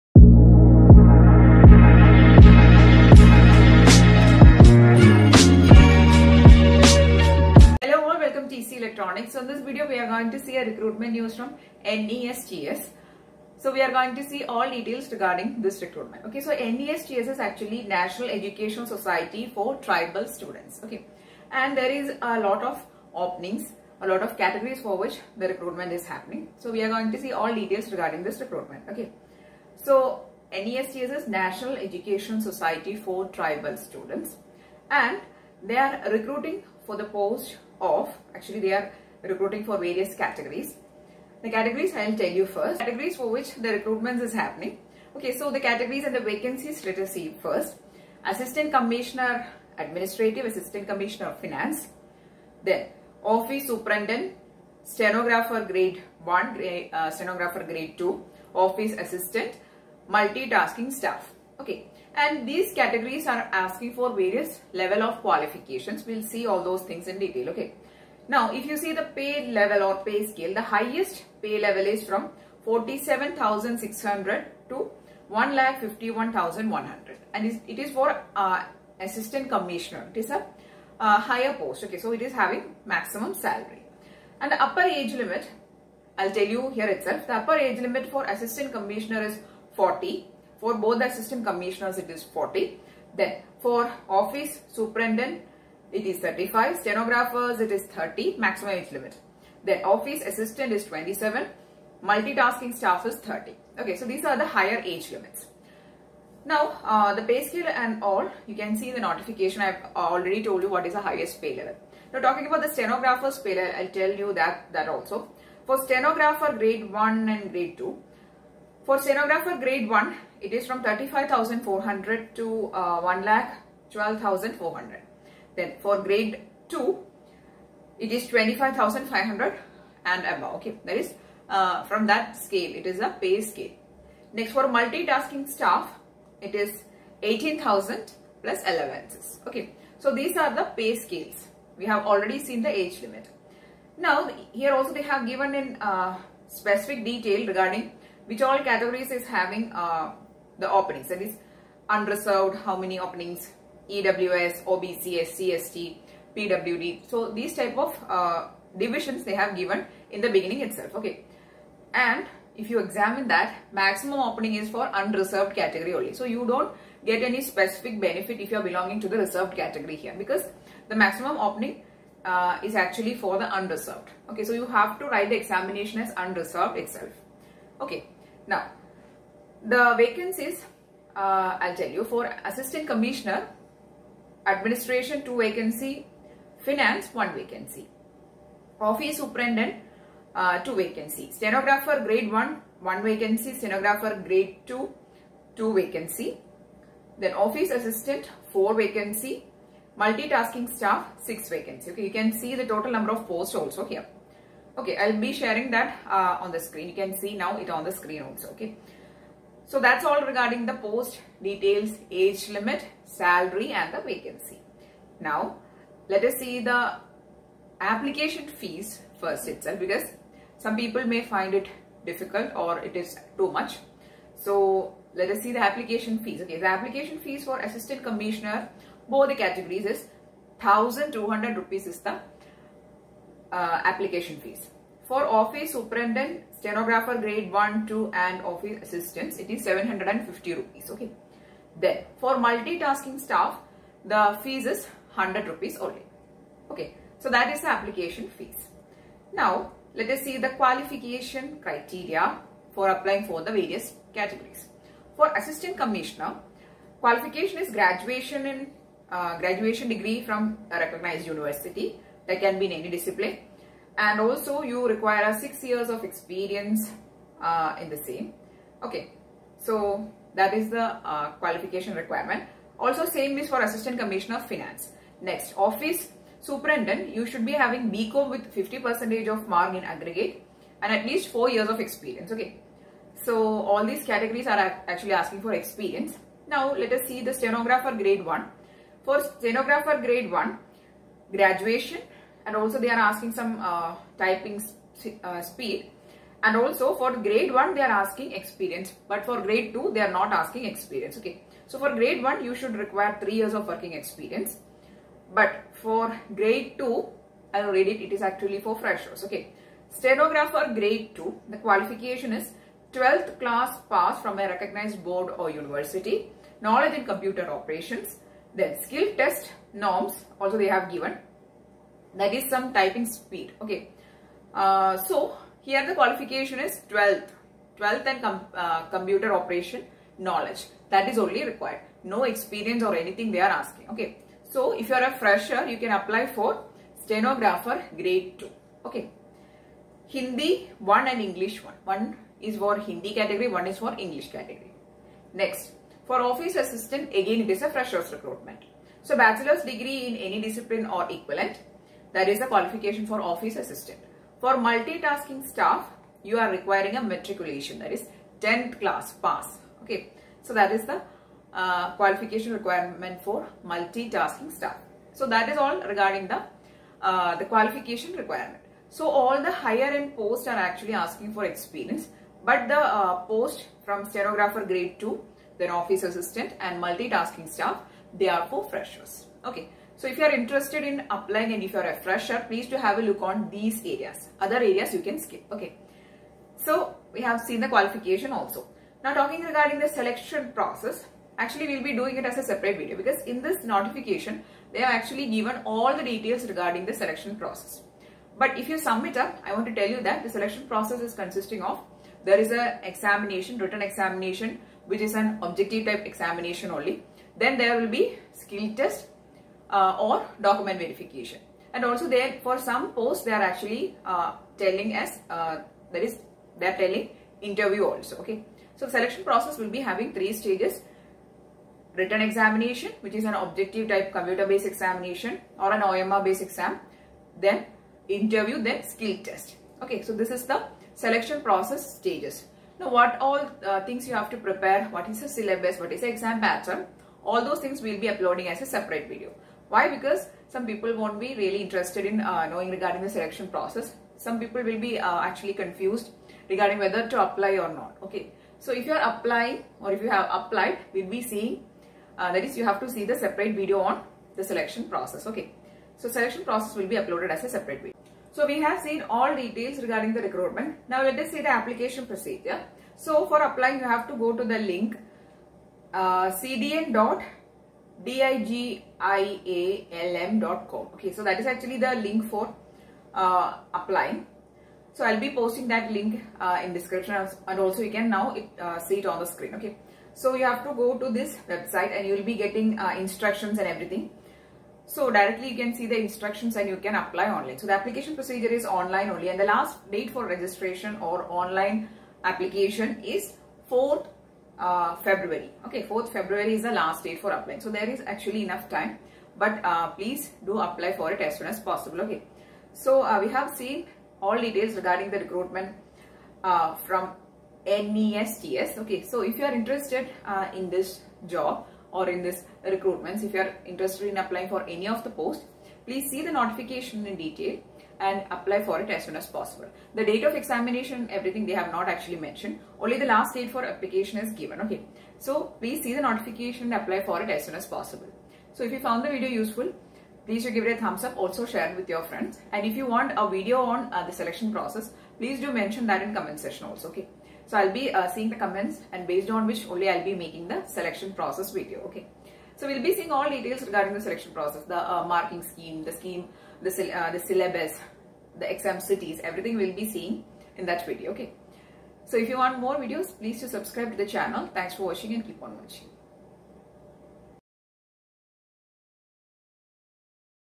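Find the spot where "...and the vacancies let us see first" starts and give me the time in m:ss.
0:46.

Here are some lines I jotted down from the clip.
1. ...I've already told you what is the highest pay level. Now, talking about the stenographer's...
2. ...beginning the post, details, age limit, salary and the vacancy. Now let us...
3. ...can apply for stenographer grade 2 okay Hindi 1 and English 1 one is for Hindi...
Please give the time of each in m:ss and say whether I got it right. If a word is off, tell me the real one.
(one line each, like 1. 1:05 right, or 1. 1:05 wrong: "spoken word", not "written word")
1. 1:49 right
2. 3:30 wrong: "regarding", not "beginning"
3. 5:35 right.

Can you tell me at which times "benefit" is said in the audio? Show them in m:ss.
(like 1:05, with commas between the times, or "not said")
2:47.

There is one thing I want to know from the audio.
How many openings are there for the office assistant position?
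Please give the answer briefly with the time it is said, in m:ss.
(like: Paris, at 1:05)
4, at 3:18.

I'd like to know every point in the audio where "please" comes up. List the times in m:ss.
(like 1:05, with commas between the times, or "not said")
6:22, 8:19, 8:35, 8:45, 8:50, 8:55, 9:13.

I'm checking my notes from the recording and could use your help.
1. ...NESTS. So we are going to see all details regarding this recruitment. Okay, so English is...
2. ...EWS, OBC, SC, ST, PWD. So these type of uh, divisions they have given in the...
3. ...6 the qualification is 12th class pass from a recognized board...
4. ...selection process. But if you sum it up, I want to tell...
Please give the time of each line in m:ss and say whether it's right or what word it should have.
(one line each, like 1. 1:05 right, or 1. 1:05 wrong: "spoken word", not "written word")
1. 0:12 wrong: "NESTS", not "English"
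2. 2:33 right
3. 5:11 wrong: "2", not "6"
4. 6:36 right.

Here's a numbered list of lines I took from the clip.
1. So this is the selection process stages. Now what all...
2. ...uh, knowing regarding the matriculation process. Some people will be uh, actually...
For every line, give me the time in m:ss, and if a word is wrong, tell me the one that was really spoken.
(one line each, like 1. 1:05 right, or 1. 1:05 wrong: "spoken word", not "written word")
1. 7:10 right
2. 7:22 wrong: "selection", not "matriculation".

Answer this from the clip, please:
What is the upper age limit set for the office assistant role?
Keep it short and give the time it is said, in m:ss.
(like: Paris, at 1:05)
27, at 1:40.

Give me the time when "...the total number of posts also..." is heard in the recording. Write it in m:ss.
3:22.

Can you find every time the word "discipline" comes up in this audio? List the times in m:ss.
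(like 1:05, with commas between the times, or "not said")
4:22, 5:50.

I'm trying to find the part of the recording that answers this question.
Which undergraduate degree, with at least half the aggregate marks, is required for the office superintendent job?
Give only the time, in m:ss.
4:37.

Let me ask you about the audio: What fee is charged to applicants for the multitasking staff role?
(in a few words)
100 rupees.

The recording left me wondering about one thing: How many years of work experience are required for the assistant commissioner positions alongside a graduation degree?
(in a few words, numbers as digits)
6 years.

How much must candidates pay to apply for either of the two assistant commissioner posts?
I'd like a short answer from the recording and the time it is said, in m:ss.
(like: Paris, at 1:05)
1200 rupees, at 3:50.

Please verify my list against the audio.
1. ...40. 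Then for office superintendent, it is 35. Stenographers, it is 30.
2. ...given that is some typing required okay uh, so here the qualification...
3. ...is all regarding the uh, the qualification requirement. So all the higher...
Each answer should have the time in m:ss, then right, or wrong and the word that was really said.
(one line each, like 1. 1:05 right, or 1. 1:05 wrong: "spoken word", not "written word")
1. 1:32 right
2. 5:20 wrong: "speed", not "required"
3. 6:05 right.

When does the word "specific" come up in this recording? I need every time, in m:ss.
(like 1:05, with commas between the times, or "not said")
2:26, 2:47.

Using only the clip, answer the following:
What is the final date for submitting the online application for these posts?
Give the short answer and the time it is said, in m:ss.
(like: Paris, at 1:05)
4 February, at 8:13.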